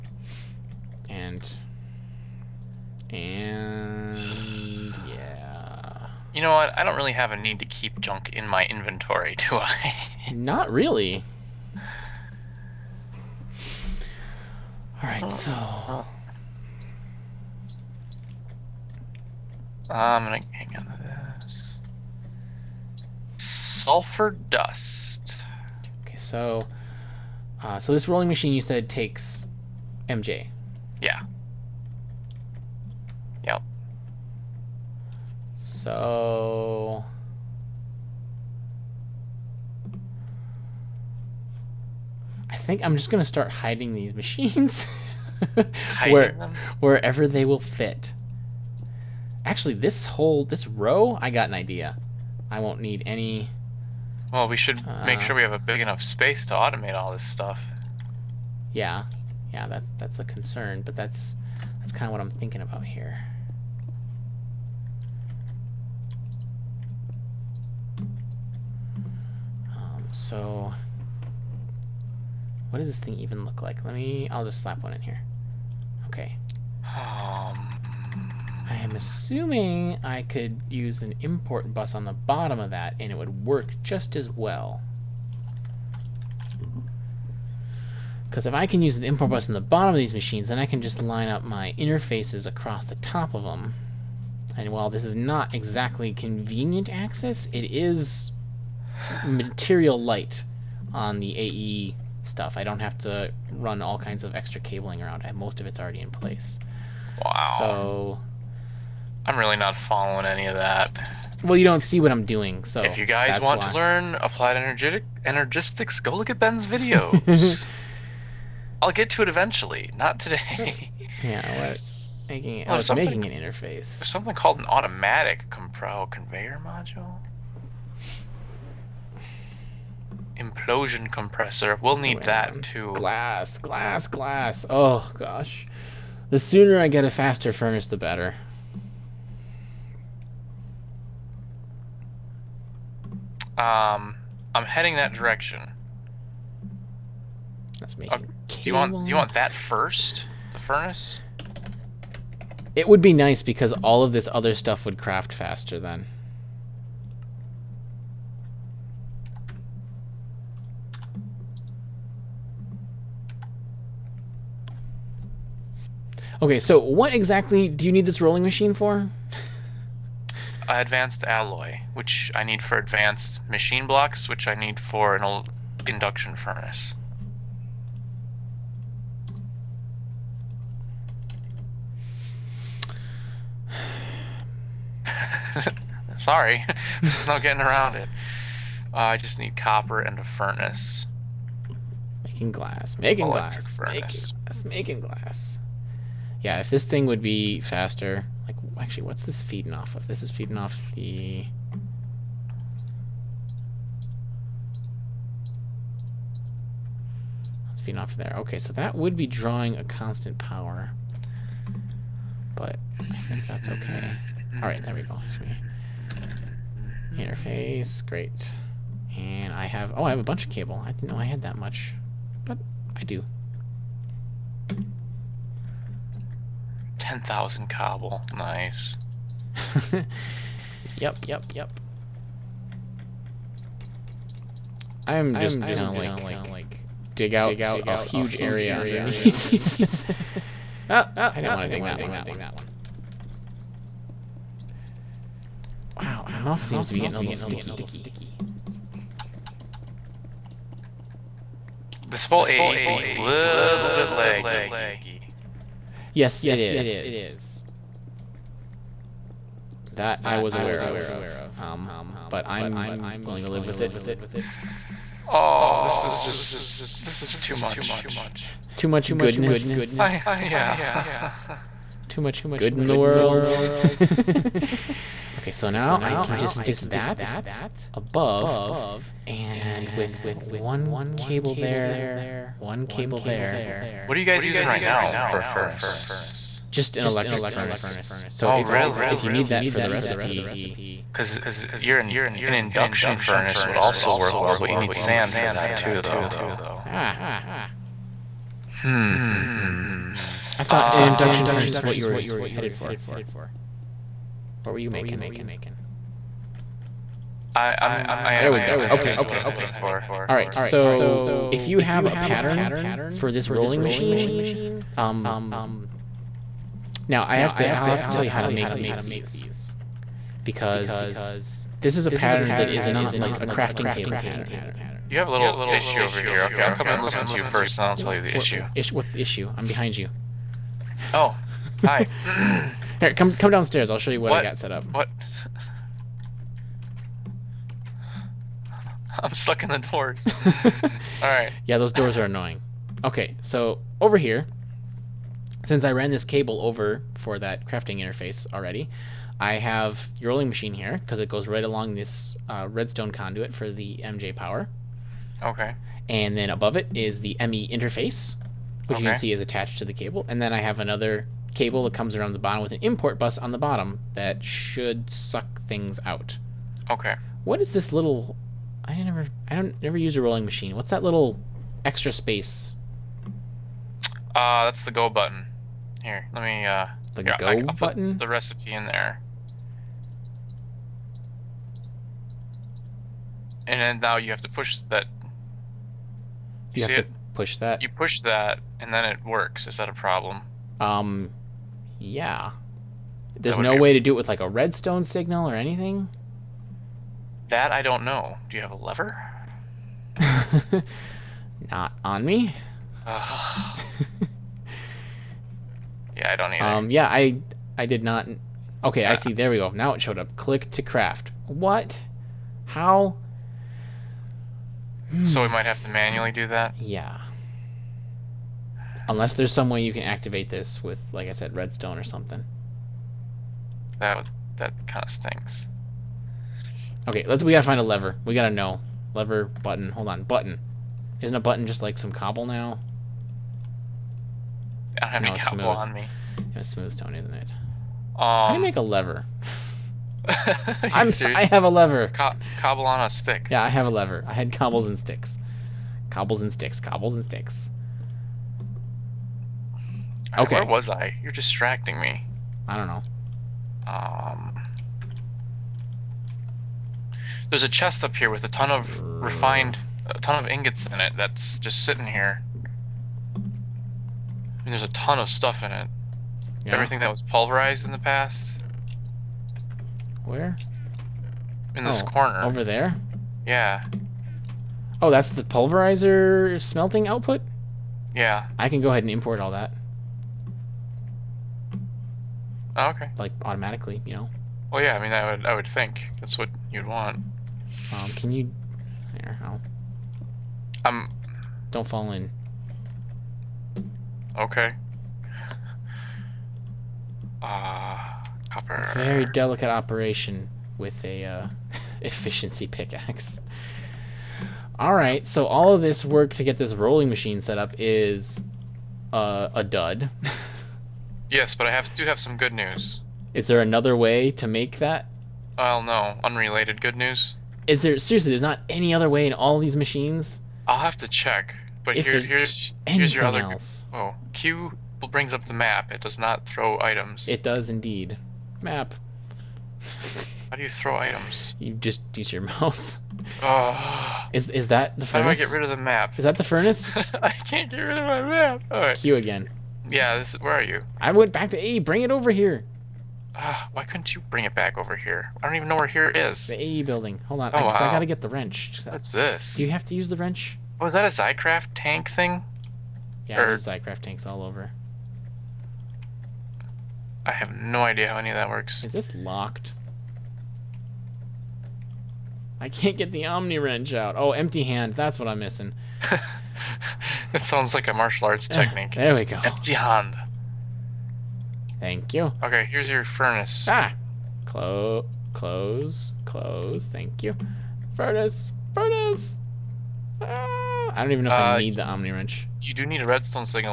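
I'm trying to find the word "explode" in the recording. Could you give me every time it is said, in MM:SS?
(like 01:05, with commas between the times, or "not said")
not said.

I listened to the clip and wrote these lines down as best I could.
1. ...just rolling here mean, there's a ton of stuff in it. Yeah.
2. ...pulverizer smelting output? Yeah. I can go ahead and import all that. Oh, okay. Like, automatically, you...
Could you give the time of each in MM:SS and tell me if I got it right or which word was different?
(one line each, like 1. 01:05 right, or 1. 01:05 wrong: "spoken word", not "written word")
1. 07:41 wrong: "sitting", not "rolling"
2. 07:55 right.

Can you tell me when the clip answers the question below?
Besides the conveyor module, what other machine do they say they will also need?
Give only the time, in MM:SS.
02:10.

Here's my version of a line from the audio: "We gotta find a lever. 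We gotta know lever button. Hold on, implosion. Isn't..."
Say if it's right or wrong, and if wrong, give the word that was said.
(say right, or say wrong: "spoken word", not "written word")
wrong: "button", not "implosion".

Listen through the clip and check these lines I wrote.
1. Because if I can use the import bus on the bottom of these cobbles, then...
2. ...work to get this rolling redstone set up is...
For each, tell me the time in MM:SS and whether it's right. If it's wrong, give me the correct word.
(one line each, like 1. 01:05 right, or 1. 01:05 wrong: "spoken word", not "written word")
1. 01:28 wrong: "machines", not "cobbles"
2. 08:26 wrong: "machine", not "redstone".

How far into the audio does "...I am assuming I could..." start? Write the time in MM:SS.
01:18.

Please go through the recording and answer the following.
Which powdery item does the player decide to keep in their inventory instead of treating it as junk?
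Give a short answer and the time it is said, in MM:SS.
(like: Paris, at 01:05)
Sulfur dust, at 00:23.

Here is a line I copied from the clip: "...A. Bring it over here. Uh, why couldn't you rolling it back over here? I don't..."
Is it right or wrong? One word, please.
wrong.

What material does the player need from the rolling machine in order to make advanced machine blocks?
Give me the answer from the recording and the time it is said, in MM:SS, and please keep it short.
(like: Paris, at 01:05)
advanced alloy, at 02:50.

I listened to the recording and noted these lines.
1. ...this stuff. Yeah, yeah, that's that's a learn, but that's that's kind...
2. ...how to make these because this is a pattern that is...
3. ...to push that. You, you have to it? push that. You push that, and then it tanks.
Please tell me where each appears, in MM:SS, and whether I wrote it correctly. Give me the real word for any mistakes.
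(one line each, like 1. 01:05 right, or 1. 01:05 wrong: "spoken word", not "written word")
1. 00:57 wrong: "concern", not "learn"
2. 05:18 right
3. 06:24 wrong: "works", not "tanks".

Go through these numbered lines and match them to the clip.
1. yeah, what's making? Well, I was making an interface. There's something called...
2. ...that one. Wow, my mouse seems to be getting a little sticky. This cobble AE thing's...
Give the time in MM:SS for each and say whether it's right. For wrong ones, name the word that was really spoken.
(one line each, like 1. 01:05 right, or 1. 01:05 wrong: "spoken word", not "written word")
1. 02:01 right
2. 04:01 wrong: "whole", not "cobble".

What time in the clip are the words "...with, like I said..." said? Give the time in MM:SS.
07:00.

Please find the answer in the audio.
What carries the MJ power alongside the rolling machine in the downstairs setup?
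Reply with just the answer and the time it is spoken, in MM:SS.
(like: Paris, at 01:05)
redstone conduit, at 05:52.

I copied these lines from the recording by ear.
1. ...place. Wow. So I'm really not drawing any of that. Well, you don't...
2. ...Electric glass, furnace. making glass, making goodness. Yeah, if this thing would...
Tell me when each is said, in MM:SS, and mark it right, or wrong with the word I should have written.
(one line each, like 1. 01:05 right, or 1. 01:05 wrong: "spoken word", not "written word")
1. 01:46 wrong: "following", not "drawing"
2. 03:13 wrong: "glass", not "goodness".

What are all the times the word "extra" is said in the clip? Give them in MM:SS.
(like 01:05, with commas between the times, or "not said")
01:44, 06:11.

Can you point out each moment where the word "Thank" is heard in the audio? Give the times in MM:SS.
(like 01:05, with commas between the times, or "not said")
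09:31, 09:36.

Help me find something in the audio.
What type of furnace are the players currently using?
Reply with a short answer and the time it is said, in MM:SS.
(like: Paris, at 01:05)
electric furnace, at 04:47.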